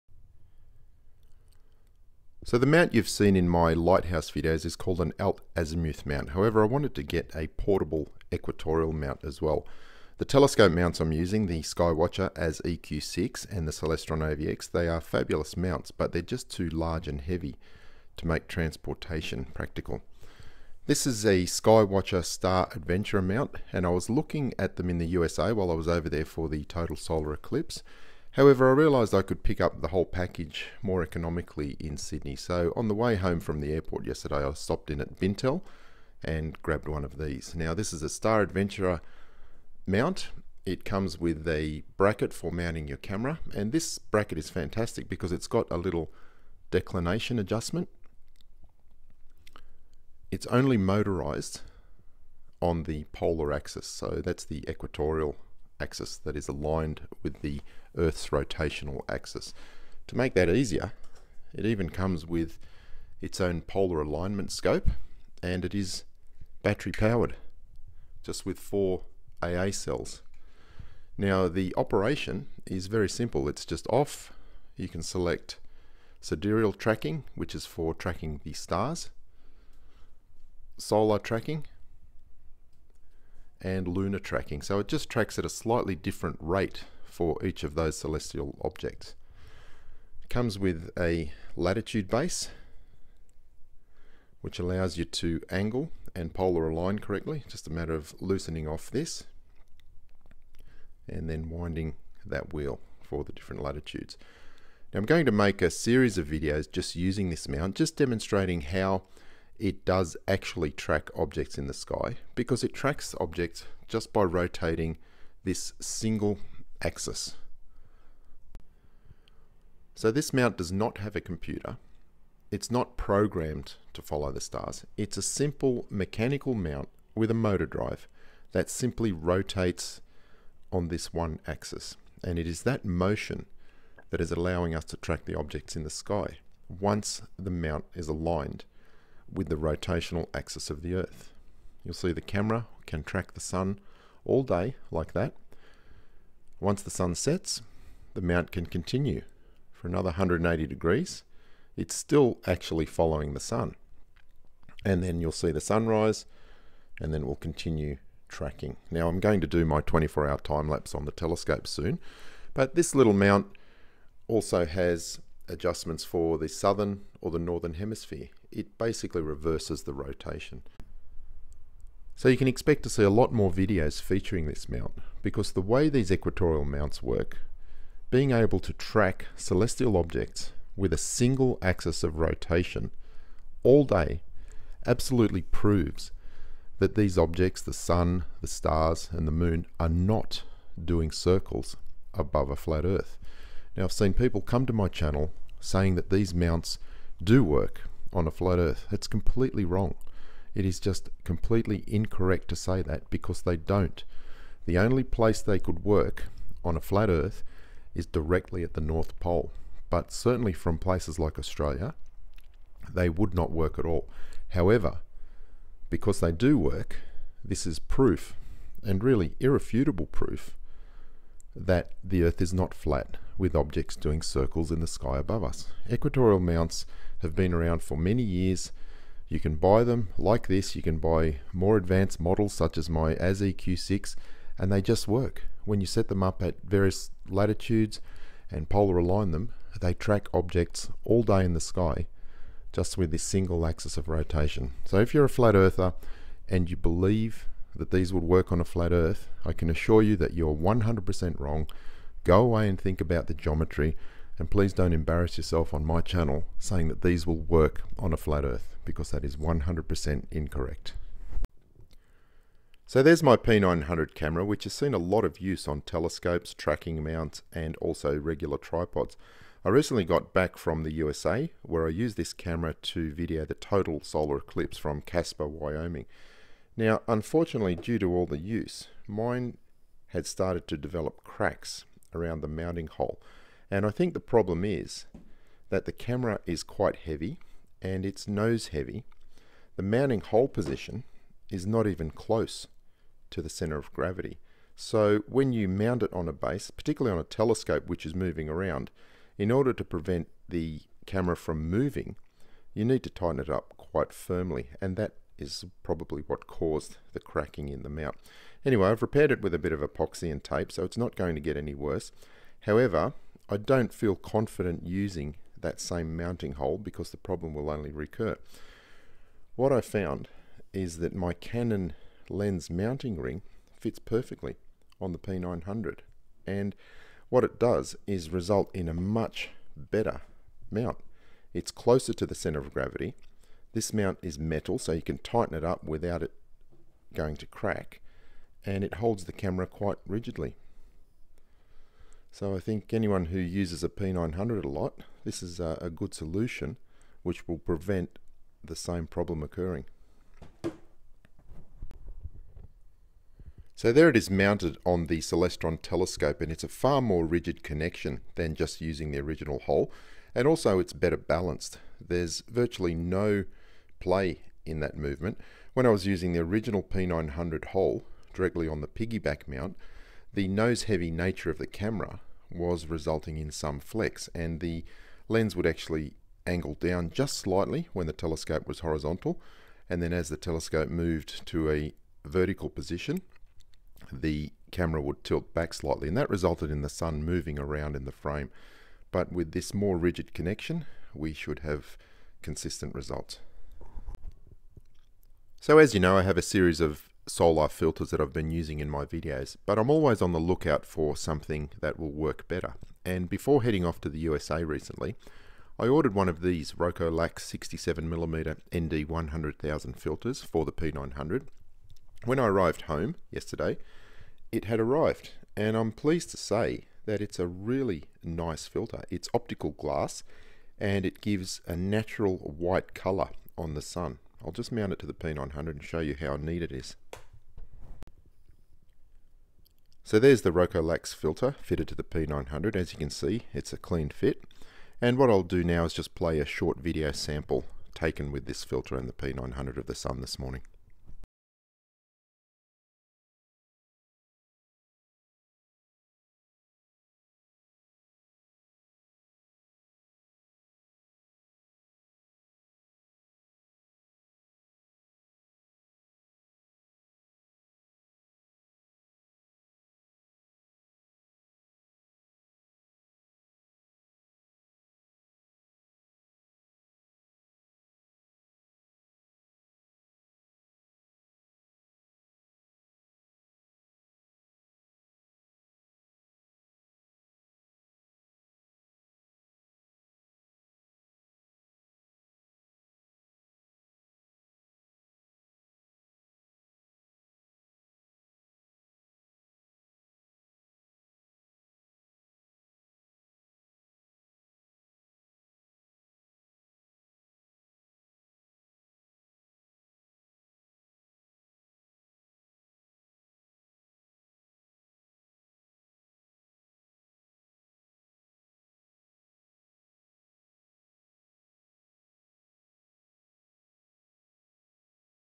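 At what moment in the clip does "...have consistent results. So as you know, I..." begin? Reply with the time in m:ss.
6:31.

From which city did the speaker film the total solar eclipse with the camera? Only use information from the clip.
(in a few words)
Casper, Wyoming.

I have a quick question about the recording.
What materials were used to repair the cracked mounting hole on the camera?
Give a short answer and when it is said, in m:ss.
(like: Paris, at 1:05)
Epoxy and tape, at 5:09.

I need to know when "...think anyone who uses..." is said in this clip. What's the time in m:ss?
5:42.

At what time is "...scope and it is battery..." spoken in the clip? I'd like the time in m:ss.
1:04.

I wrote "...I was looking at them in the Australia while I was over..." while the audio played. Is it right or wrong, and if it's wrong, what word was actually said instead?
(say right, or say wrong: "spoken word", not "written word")
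wrong: "USA", not "Australia".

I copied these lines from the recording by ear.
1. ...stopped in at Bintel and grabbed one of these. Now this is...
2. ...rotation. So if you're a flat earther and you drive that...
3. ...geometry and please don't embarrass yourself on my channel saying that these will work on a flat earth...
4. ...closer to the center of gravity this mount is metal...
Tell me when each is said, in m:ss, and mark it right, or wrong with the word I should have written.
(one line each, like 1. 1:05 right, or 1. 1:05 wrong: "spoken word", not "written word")
1. 0:34 right
2. 4:04 wrong: "believe", not "drive"
3. 4:13 right
4. 5:31 right.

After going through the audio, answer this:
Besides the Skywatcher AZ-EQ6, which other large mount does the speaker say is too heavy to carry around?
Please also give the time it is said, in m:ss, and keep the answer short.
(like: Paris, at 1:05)
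Celestron AVX, at 0:13.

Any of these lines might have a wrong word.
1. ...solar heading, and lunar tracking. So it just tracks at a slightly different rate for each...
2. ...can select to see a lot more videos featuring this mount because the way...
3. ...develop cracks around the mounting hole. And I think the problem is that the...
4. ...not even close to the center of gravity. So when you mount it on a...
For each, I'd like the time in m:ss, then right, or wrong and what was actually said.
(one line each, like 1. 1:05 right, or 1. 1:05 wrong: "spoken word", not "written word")
1. 1:20 wrong: "tracking", not "heading"
2. 2:52 wrong: "expect", not "select"
3. 4:40 right
4. 4:51 right.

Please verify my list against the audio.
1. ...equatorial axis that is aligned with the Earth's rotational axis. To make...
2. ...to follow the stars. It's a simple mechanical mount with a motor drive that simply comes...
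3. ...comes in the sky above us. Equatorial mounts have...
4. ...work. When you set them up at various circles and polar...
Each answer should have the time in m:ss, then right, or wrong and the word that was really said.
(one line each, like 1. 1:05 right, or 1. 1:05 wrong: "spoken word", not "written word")
1. 0:54 right
2. 2:03 wrong: "rotates", not "comes"
3. 3:44 wrong: "circles", not "comes"
4. 3:55 wrong: "latitudes", not "circles".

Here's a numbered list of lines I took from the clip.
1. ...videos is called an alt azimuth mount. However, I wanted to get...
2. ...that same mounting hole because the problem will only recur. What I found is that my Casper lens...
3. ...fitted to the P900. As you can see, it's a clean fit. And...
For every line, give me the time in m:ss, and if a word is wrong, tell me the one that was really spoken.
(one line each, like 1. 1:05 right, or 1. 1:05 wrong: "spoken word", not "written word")
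1. 0:04 right
2. 5:15 wrong: "Canon", not "Casper"
3. 7:11 right.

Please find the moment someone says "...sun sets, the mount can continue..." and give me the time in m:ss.
2:26.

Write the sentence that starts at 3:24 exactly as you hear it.
The only place they could work on a flat earth is directly at the North Pole.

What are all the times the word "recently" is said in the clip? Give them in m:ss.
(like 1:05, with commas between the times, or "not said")
4:29, 6:44.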